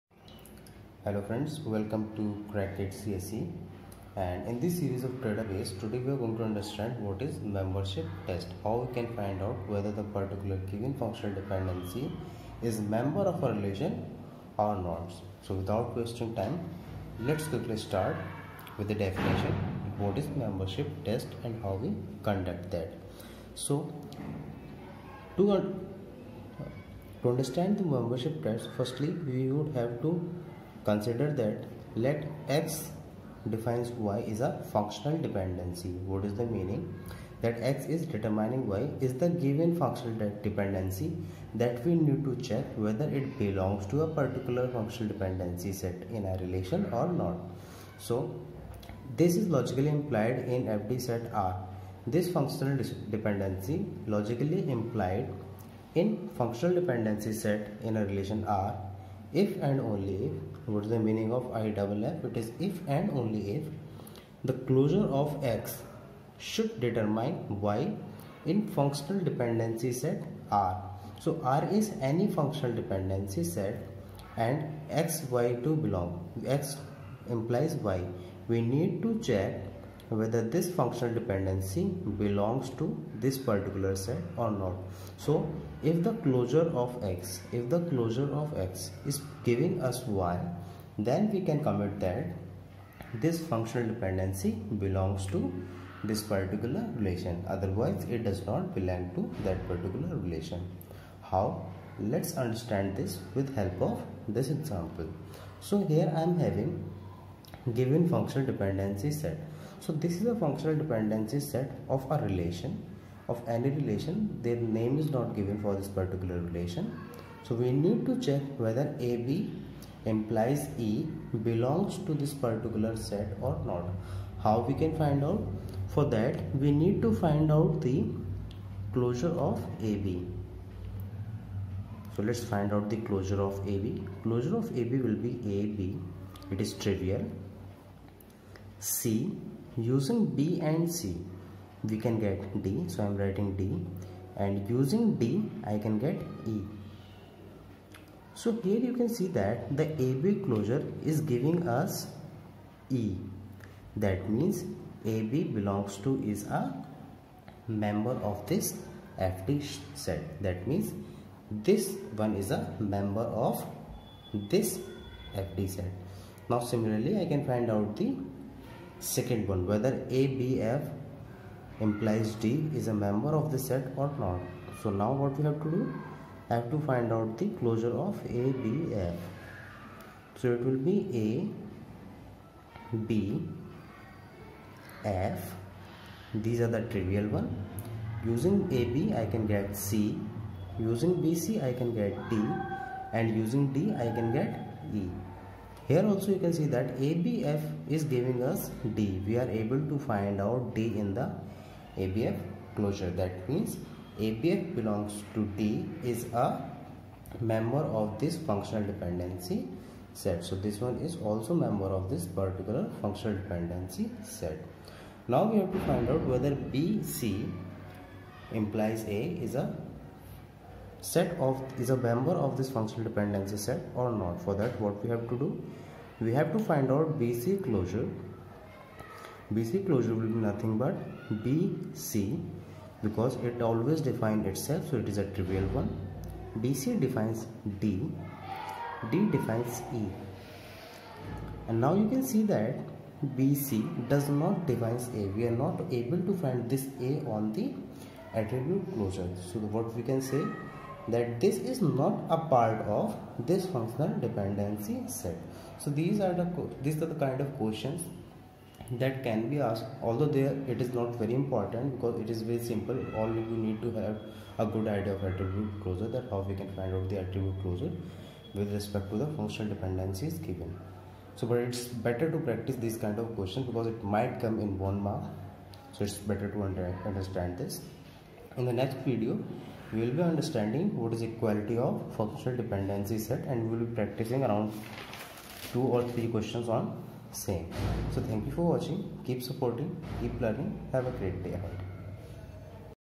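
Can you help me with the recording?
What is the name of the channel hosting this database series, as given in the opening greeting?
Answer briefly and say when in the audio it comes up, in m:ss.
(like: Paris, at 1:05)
Cracked CSE, at 0:02.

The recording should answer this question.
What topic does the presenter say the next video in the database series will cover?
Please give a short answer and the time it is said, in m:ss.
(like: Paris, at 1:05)
Equality of functional dependency set, at 4:41.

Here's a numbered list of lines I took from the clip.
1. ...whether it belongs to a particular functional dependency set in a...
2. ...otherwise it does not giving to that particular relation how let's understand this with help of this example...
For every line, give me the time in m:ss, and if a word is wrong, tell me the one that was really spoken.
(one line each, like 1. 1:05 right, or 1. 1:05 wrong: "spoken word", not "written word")
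1. 0:42 right
2. 1:37 wrong: "belong", not "giving".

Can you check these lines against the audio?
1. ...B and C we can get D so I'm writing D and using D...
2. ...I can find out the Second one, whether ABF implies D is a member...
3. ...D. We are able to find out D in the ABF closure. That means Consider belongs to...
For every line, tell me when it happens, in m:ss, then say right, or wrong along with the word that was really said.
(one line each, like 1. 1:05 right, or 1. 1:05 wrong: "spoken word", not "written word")
1. 2:20 right
2. 2:47 right
3. 3:18 wrong: "ABF", not "Consider".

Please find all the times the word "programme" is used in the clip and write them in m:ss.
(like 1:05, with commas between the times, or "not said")
not said.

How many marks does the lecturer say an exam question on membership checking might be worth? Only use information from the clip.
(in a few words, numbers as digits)
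1 mark.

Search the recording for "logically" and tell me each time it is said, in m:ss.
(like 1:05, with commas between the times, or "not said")
0:49, 0:54.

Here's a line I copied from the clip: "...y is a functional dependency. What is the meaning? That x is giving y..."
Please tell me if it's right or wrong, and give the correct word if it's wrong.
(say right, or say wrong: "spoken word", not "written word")
wrong: "determining", not "giving".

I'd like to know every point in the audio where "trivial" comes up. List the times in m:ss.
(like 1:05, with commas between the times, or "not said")
2:16, 3:06, 3:55.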